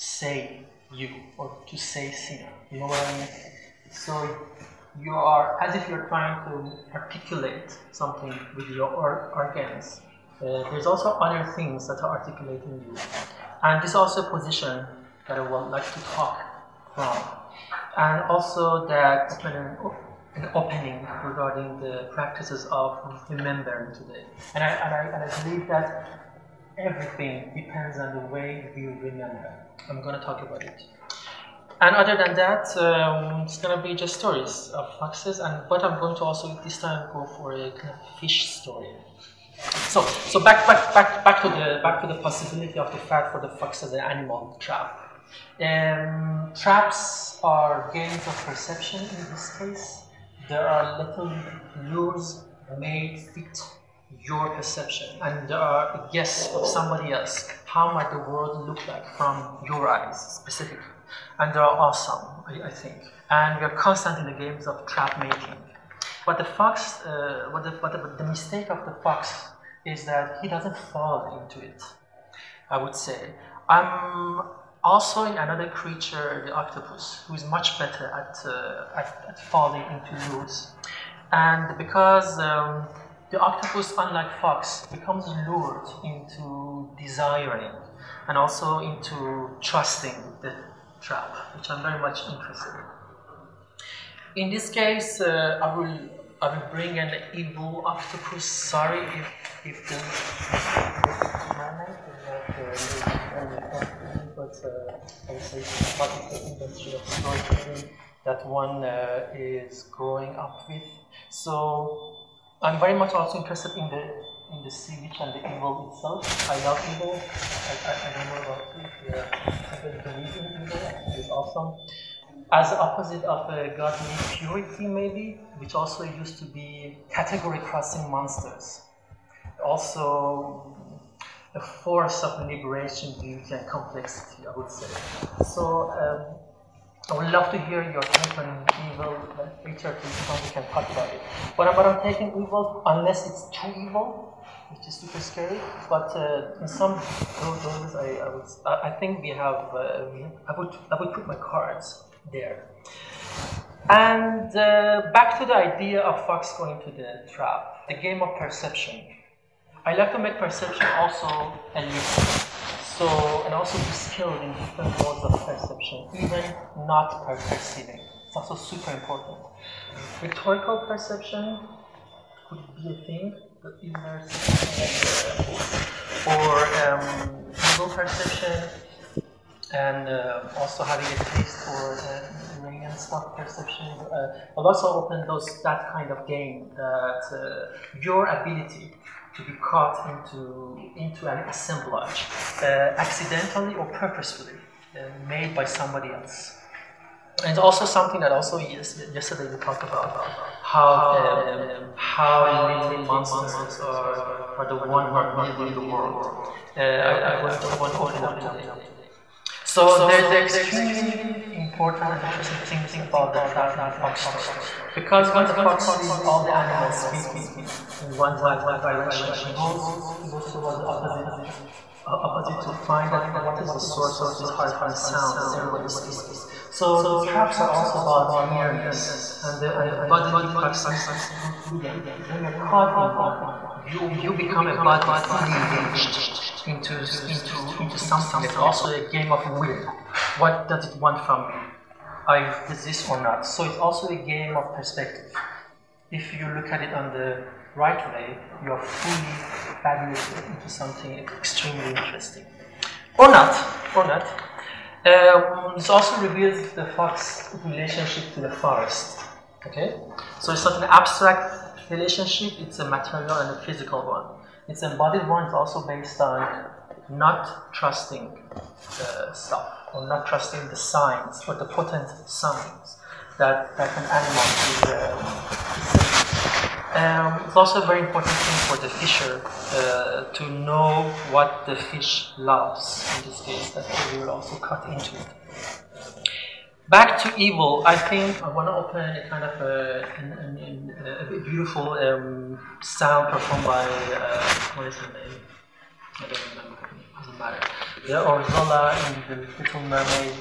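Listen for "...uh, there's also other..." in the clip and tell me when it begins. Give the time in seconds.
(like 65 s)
10 s.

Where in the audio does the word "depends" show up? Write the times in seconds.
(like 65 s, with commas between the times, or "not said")
27 s.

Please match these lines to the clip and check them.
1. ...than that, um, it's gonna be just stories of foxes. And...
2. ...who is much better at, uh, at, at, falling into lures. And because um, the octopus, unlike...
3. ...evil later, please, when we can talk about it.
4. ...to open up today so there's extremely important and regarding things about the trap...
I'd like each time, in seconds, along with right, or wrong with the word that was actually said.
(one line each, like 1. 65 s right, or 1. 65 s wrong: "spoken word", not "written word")
1. 32 s right
2. 77 s right
3. 138 s right
4. 207 s wrong: "interesting", not "regarding".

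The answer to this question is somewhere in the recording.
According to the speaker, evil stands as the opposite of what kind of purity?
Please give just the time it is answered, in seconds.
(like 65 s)
123 s.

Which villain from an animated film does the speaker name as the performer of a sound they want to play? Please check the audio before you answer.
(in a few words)
Ursula.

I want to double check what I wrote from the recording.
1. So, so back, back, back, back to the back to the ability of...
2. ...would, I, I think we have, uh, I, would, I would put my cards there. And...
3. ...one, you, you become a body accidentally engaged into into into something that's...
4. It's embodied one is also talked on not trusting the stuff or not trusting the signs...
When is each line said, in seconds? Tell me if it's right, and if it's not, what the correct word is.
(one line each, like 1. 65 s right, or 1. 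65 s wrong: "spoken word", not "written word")
1. 39 s wrong: "possibility", not "ability"
2. 148 s right
3. 233 s wrong: "fully", not "accidentally"
4. 264 s wrong: "based", not "talked".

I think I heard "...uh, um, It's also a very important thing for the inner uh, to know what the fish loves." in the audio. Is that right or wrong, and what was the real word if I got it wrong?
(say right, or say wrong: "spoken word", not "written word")
wrong: "fisher", not "inner".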